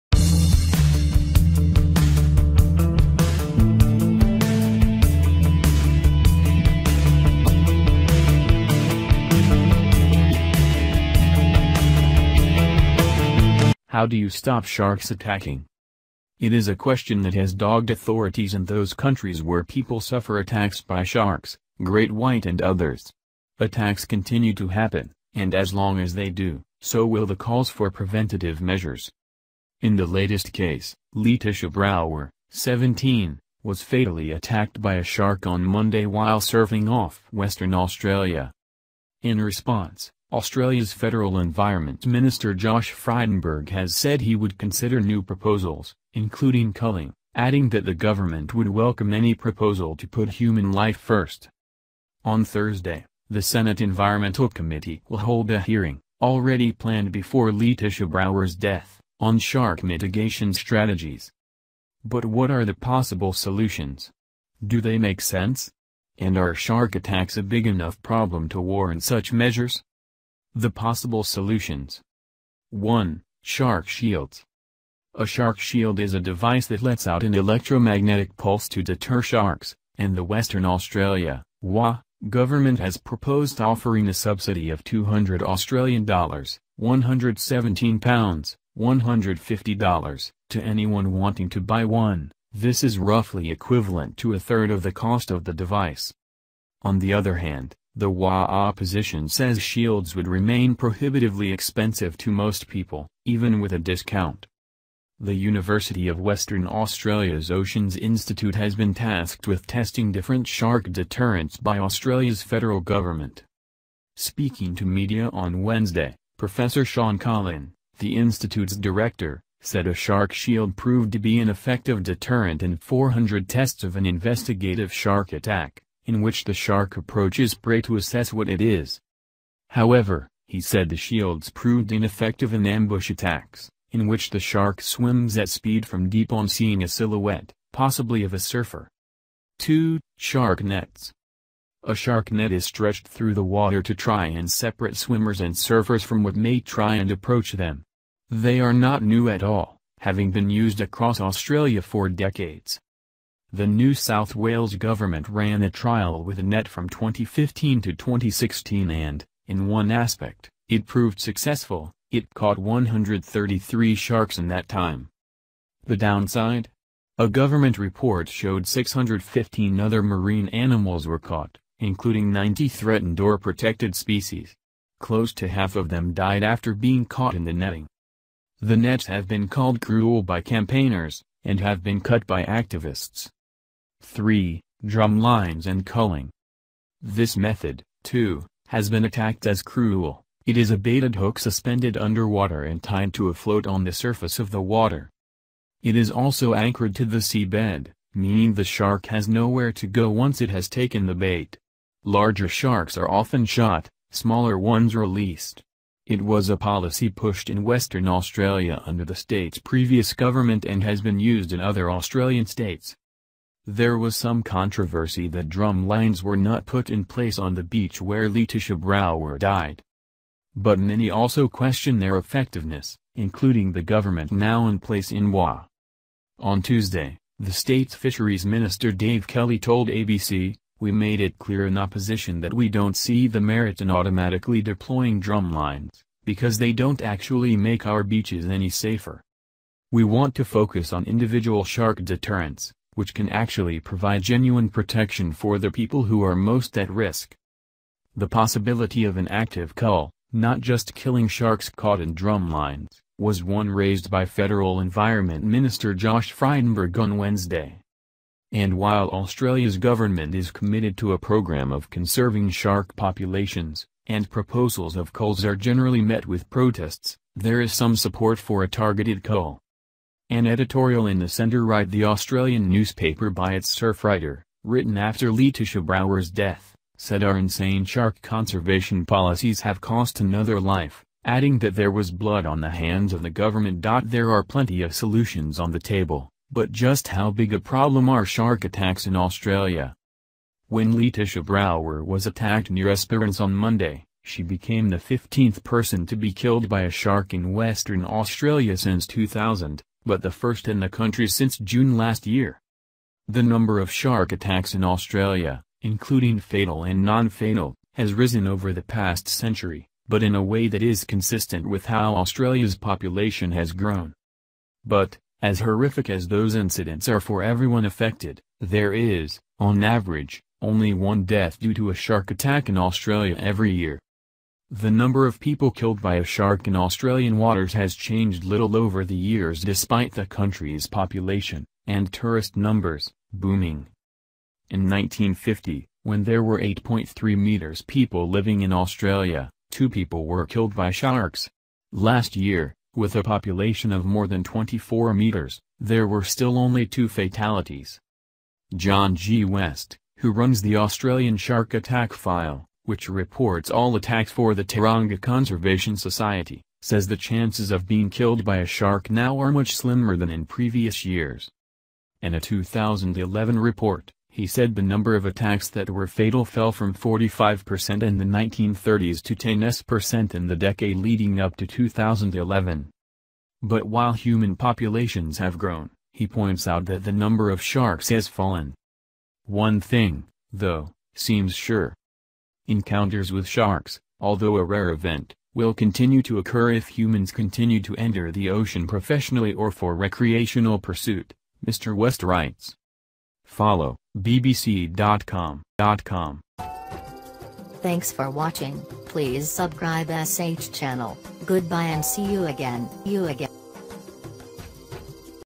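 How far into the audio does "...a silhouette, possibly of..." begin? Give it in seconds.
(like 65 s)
136 s.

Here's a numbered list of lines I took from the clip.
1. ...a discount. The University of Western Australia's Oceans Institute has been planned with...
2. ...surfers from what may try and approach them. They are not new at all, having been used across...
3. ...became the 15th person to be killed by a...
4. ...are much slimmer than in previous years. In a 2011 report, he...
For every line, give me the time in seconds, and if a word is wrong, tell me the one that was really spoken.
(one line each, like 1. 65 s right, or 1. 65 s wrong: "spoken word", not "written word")
1. 103 s wrong: "tasked", not "planned"
2. 145 s right
3. 294 s right
4. 359 s right.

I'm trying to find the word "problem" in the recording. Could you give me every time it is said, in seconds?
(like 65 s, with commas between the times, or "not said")
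68 s, 287 s.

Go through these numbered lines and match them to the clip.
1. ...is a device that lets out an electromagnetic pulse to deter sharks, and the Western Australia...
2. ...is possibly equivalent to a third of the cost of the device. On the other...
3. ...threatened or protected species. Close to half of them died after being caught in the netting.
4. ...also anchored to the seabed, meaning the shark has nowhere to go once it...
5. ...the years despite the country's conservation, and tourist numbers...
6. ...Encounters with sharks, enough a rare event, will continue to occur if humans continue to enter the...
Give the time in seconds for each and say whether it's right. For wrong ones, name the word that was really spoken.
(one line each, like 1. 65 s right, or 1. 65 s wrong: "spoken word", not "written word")
1. 75 s right
2. 92 s wrong: "roughly", not "possibly"
3. 172 s right
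4. 196 s right
5. 329 s wrong: "population", not "conservation"
6. 382 s wrong: "although", not "enough".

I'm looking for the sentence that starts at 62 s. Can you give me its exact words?
But what are the possible solutions?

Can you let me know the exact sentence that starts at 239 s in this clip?
We want to focus on individual shark deterrence, which can actually provide genuine protection for the people who are most at risk.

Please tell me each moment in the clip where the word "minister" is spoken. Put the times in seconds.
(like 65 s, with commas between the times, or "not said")
42 s, 228 s, 255 s.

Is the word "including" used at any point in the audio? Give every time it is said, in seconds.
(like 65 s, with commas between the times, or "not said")
46 s, 171 s, 223 s, 305 s.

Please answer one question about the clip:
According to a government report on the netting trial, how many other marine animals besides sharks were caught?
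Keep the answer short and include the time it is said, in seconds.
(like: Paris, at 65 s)
615, at 168 s.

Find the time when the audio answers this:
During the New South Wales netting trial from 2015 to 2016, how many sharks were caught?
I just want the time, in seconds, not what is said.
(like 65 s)
162 s.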